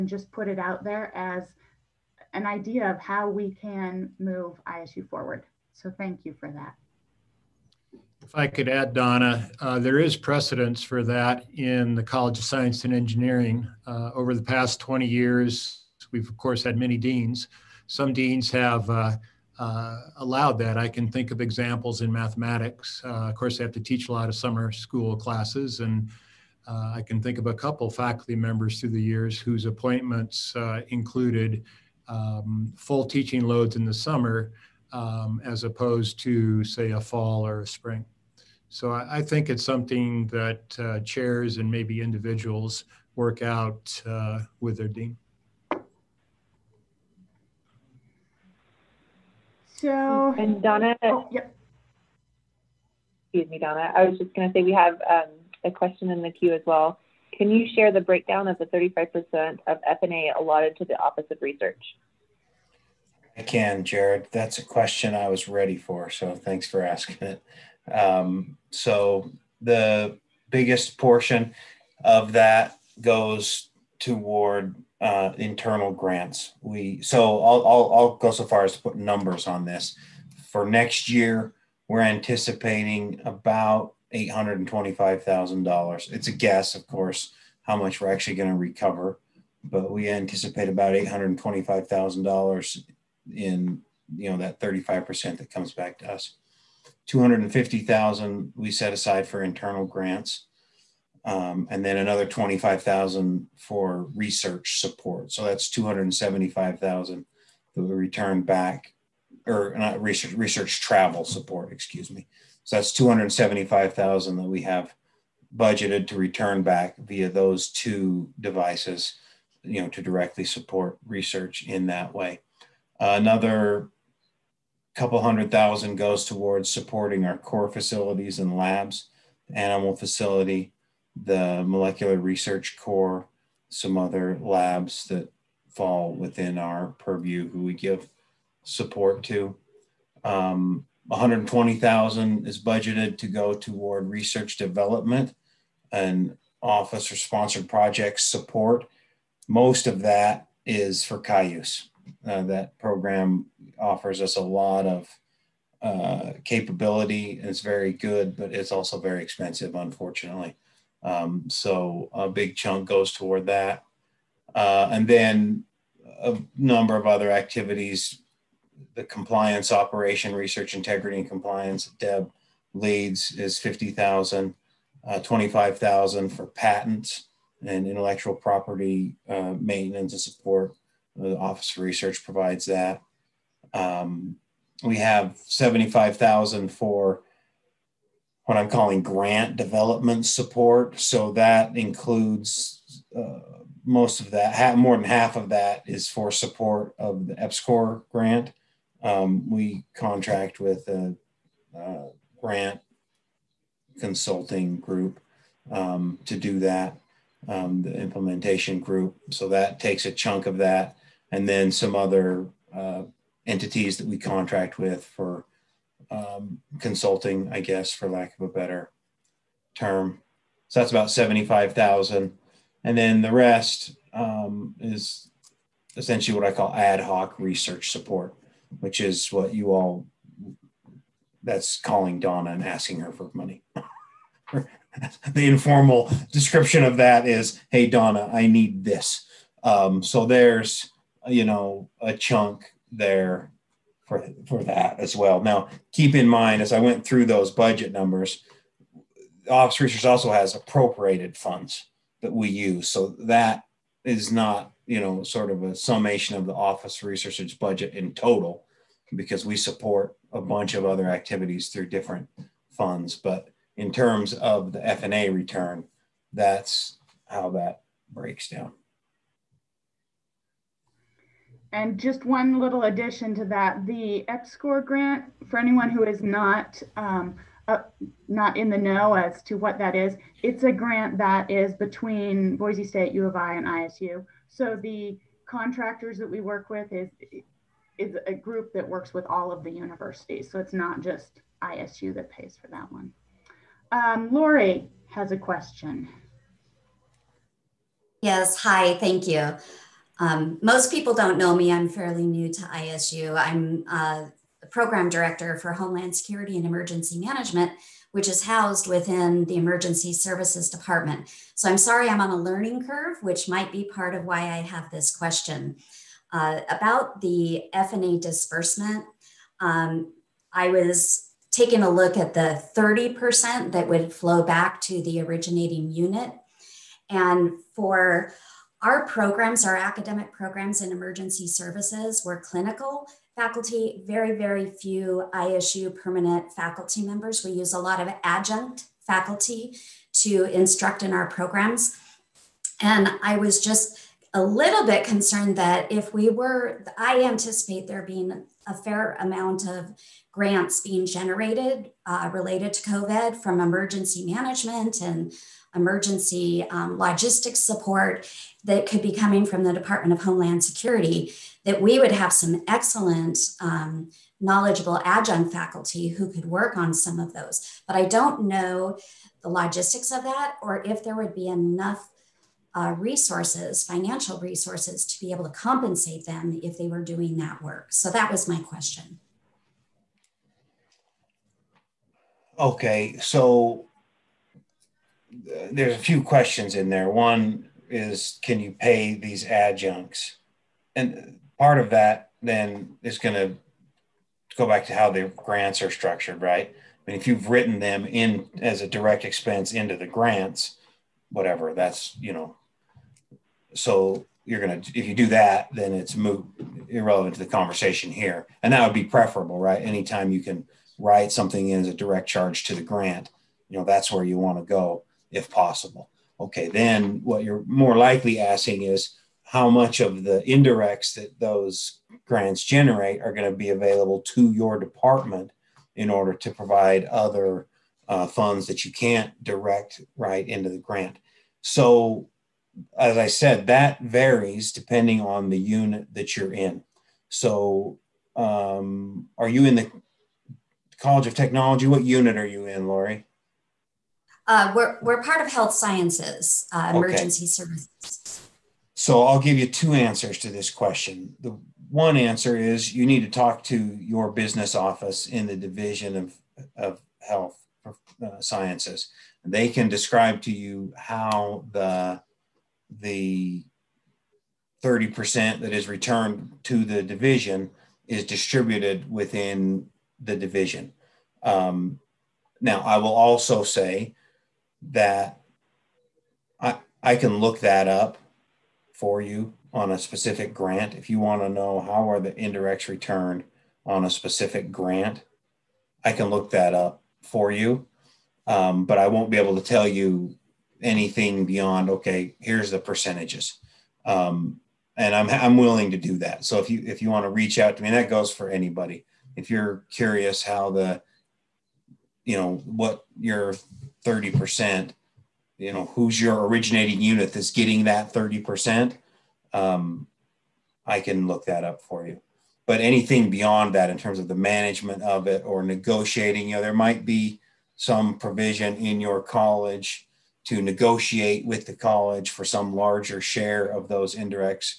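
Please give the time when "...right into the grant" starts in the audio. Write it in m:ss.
7:10.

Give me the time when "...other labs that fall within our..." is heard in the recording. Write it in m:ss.
2:13.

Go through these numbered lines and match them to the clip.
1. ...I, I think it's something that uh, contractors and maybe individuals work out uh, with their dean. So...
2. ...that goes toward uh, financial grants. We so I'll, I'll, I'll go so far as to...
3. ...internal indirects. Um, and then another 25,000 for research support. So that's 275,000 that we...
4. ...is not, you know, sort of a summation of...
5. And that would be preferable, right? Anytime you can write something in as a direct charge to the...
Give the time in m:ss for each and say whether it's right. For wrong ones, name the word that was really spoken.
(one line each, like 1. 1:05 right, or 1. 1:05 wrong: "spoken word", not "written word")
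1. 0:38 wrong: "chairs", not "contractors"
2. 1:12 wrong: "internal", not "financial"
3. 1:39 wrong: "grants", not "indirects"
4. 4:14 right
5. 6:48 right.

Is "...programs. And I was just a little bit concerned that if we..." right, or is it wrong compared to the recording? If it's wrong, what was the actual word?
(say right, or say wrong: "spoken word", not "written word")
right.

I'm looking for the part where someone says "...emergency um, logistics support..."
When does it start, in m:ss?
5:55.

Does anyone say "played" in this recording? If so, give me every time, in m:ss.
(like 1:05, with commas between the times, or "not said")
not said.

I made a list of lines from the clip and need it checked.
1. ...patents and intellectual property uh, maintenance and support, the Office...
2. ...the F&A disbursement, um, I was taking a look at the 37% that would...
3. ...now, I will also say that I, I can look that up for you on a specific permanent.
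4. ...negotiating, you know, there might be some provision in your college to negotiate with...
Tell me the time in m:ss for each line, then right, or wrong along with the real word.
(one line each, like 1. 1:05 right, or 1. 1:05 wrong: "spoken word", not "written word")
1. 2:56 right
2. 5:17 wrong: "30", not "37"
3. 7:52 wrong: "grant", not "permanent"
4. 8:35 right.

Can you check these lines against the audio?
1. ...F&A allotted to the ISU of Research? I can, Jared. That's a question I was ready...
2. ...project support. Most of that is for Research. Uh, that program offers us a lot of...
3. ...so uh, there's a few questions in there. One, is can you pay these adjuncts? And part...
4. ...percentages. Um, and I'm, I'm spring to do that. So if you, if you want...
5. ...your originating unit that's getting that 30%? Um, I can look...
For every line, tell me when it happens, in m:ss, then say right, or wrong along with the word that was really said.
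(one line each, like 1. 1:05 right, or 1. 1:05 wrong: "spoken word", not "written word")
1. 0:59 wrong: "Office", not "ISU"
2. 2:27 wrong: "Cayuse", not "Research"
3. 6:23 right
4. 8:12 wrong: "willing", not "spring"
5. 8:26 right.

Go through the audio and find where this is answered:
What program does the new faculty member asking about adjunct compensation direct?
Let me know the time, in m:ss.
5:05.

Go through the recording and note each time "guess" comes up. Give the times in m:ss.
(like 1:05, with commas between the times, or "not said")
1:26, 3:37.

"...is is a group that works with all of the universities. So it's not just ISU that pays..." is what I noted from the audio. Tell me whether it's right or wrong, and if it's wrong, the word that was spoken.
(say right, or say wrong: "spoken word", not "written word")
right.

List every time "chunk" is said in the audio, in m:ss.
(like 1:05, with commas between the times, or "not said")
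2:42, 3:30, 4:02.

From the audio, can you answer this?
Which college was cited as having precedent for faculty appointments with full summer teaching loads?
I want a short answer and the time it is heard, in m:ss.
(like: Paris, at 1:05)
College of Science and Engineering, at 0:12.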